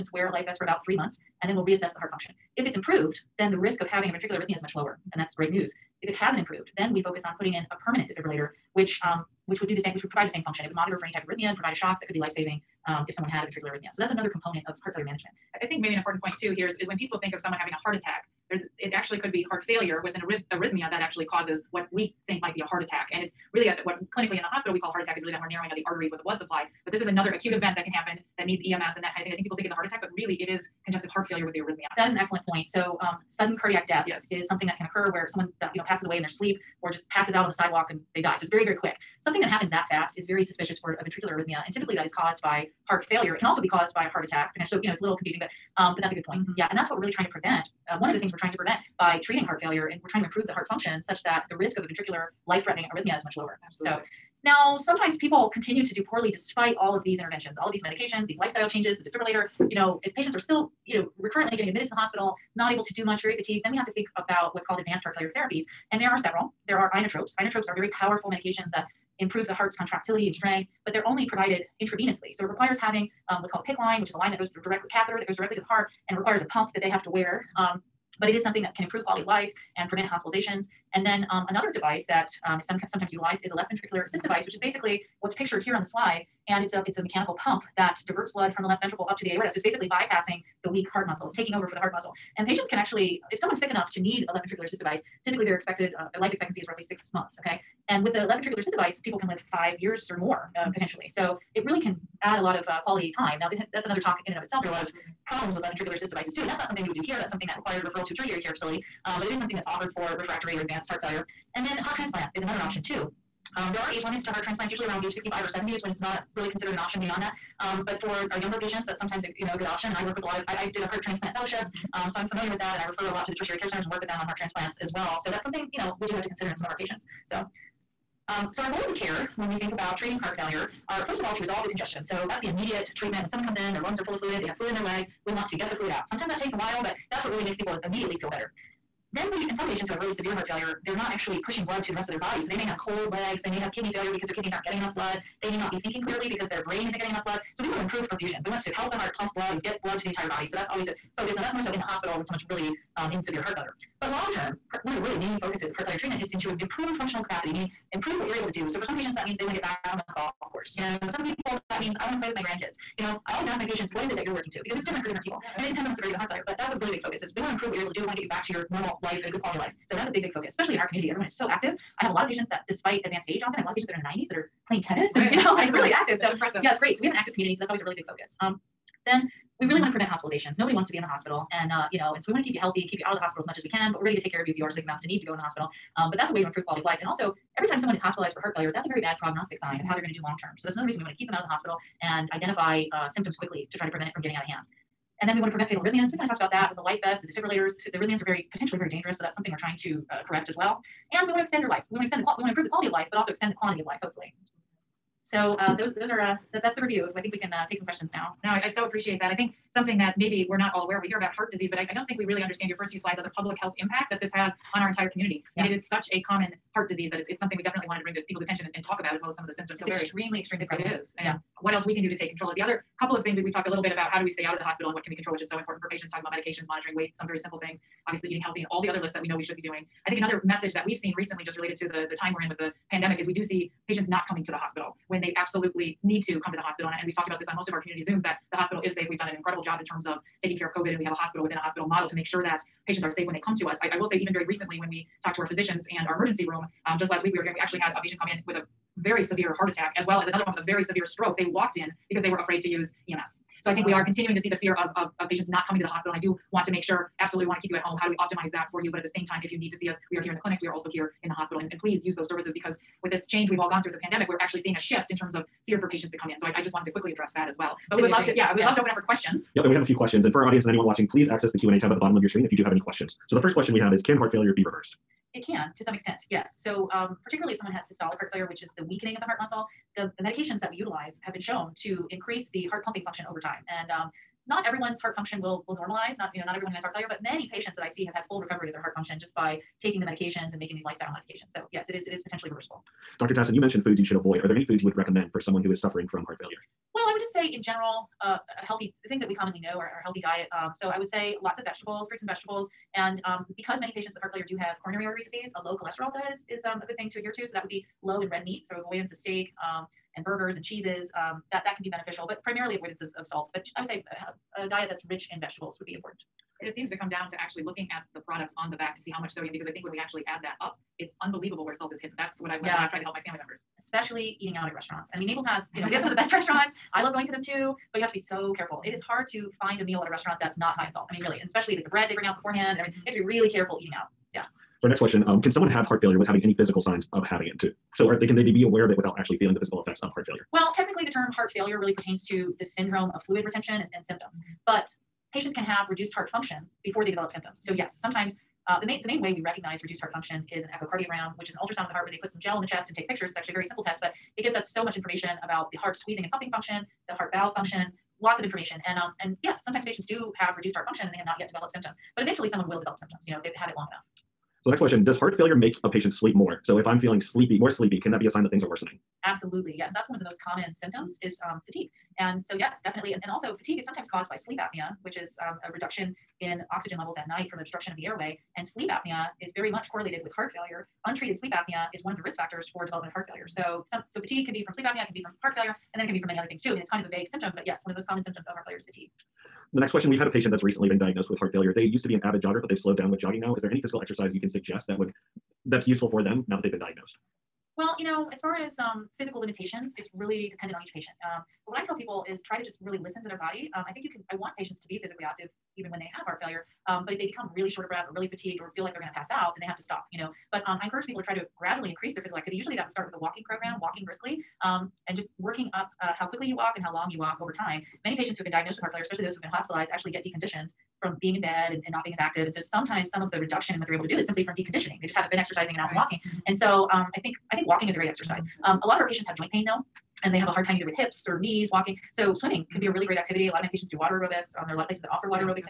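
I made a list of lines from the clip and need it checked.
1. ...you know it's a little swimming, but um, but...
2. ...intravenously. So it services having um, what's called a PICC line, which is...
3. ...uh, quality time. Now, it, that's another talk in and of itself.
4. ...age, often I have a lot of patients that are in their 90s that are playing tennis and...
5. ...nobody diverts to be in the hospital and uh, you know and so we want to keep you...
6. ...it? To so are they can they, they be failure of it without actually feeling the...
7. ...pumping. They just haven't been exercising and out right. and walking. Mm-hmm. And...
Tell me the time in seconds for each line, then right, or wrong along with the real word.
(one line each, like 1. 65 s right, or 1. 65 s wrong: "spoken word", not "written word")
1. 44 s wrong: "confusing", not "swimming"
2. 71 s wrong: "requires", not "services"
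3. 102 s right
4. 173 s right
5. 180 s wrong: "wants", not "diverts"
6. 337 s wrong: "aware", not "failure"
7. 424 s wrong: "deconditioning", not "pumping".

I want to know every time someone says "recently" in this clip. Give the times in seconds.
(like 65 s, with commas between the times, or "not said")
231 s, 244 s, 390 s.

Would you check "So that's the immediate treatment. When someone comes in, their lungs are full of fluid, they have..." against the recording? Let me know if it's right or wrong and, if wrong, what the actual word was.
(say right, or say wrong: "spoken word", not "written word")
right.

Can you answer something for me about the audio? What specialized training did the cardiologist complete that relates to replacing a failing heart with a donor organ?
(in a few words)
heart transplant fellowship.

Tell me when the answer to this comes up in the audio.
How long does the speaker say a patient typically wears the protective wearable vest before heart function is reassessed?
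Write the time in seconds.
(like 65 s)
0 s.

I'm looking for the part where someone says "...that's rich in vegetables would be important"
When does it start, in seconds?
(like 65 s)
314 s.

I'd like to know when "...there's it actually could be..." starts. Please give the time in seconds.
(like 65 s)
18 s.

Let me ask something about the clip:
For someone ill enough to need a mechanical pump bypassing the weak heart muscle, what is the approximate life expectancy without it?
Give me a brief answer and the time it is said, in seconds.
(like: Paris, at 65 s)
6 months, at 96 s.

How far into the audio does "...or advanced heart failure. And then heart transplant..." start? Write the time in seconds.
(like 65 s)
110 s.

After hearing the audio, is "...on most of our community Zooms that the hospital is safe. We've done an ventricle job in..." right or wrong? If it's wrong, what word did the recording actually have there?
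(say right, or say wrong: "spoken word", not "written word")
wrong: "incredible", not "ventricle".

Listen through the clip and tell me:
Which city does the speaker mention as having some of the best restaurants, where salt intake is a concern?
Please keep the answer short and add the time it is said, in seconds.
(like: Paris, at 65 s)
Naples, at 325 s.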